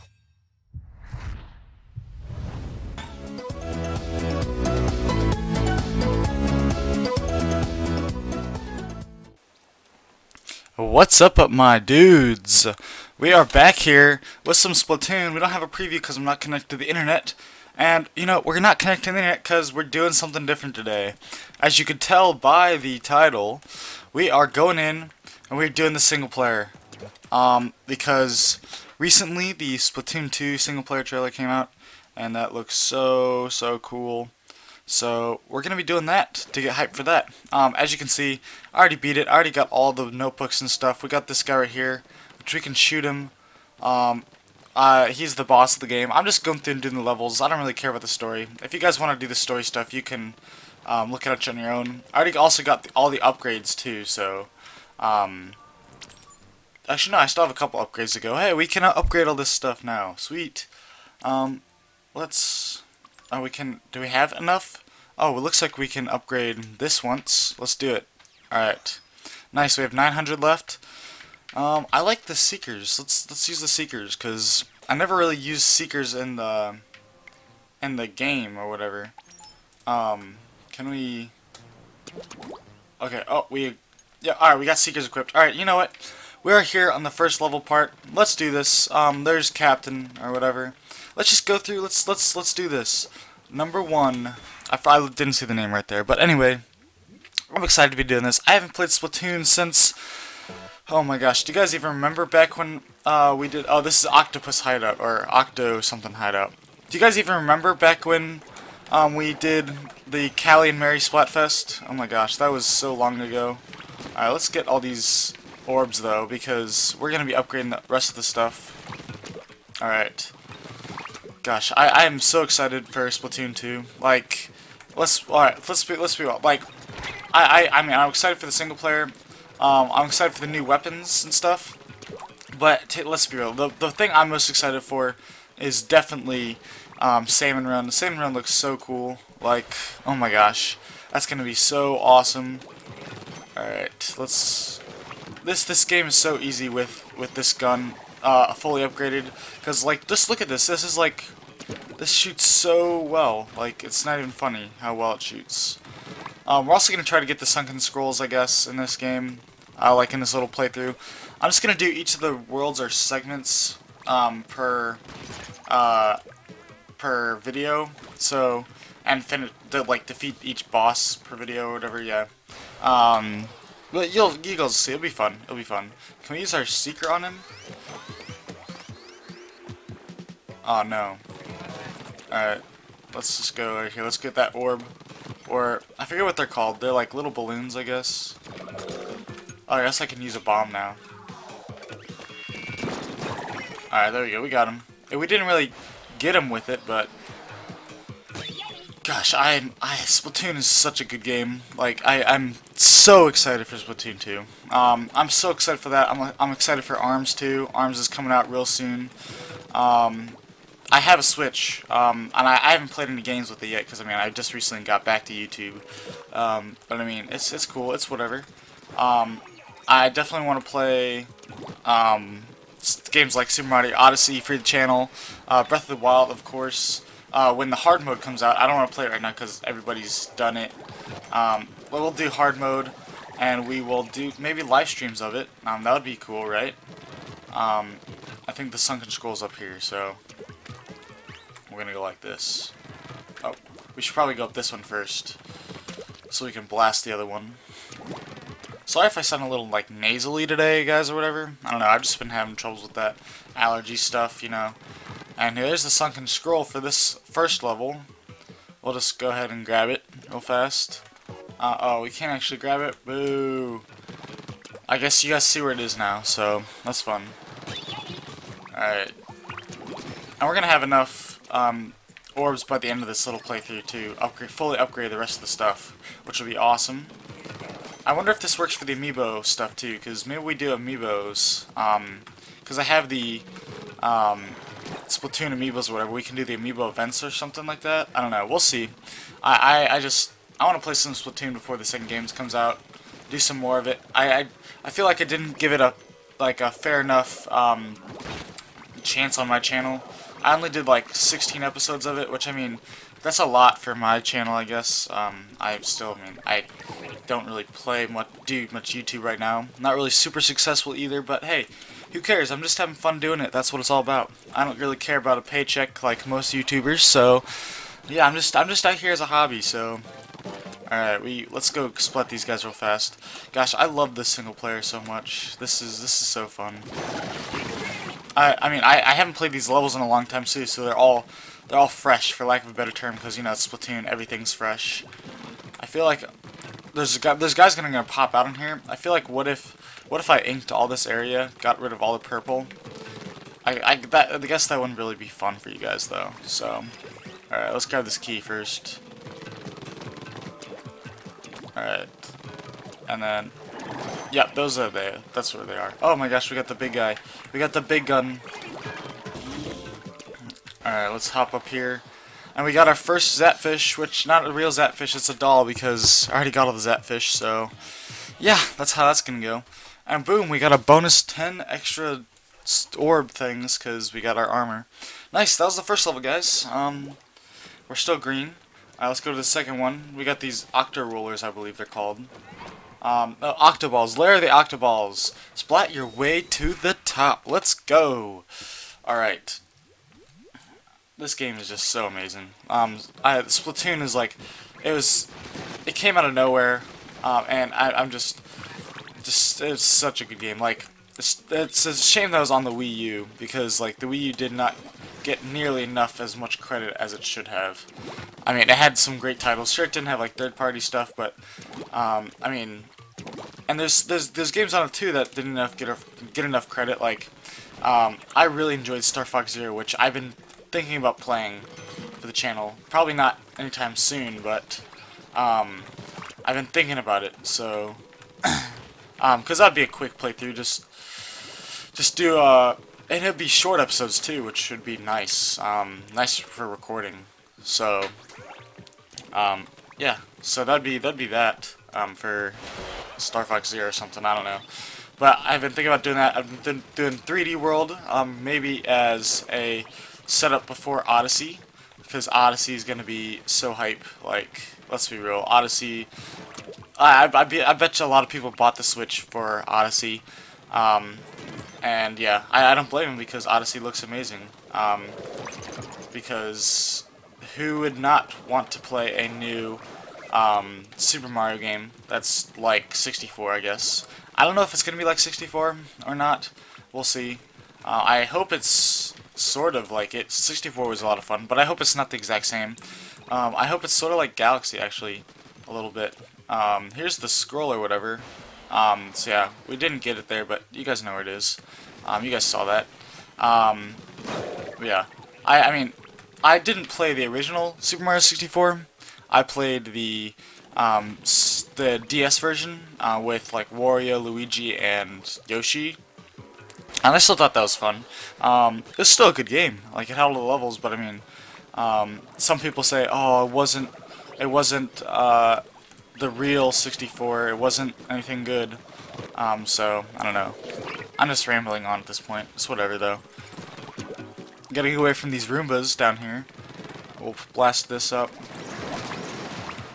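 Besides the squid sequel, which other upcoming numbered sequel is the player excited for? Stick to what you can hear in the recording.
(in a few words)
ARMS 2.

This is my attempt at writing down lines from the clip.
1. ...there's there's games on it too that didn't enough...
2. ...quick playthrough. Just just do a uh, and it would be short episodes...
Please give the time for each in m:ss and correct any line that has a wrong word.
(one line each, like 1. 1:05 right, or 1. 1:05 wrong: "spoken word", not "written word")
1. 6:54 right
2. 7:09 right.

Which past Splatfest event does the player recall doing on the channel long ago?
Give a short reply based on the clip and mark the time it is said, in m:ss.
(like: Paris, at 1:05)
Callie and Marie Splatfest, at 1:50.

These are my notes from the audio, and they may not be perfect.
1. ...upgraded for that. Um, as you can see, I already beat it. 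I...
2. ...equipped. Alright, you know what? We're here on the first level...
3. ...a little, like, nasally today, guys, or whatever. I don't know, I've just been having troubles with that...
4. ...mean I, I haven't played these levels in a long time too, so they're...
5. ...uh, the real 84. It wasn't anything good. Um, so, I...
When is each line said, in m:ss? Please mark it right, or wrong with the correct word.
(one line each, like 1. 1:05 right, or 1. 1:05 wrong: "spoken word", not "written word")
1. 0:36 wrong: "hyped", not "upgraded"
2. 1:25 right
3. 4:09 right
4. 5:28 right
5. 8:35 wrong: "64", not "84".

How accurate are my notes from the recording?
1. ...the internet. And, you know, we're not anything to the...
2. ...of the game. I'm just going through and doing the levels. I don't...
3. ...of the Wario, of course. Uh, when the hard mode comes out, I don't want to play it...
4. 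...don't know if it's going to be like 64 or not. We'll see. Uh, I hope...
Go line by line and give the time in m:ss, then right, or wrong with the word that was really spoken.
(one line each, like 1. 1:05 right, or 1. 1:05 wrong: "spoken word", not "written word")
1. 0:16 wrong: "connecting", not "anything"
2. 0:45 right
3. 3:45 wrong: "Wild", not "Wario"
4. 7:54 right.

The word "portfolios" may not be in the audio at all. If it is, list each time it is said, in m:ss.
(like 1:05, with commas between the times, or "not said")
not said.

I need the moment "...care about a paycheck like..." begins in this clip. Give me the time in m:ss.
5:14.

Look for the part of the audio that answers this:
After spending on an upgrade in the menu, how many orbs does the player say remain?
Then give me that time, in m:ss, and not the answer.
1:09.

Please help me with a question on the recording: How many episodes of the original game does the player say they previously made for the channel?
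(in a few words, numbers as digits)
16.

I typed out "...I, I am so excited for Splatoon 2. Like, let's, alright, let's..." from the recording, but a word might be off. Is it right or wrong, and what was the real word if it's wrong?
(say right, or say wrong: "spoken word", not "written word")
right.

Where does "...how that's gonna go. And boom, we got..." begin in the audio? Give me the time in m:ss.
6:08.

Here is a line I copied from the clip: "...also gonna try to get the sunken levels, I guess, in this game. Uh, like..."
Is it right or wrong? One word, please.
wrong.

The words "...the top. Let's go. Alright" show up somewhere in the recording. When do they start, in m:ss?
6:26.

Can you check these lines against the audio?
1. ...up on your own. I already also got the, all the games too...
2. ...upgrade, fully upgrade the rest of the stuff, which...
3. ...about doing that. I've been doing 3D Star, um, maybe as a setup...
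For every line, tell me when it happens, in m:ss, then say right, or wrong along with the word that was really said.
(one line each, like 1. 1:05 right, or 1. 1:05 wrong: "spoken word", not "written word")
1. 0:51 wrong: "upgrades", not "games"
2. 4:34 right
3. 7:25 wrong: "World", not "Star".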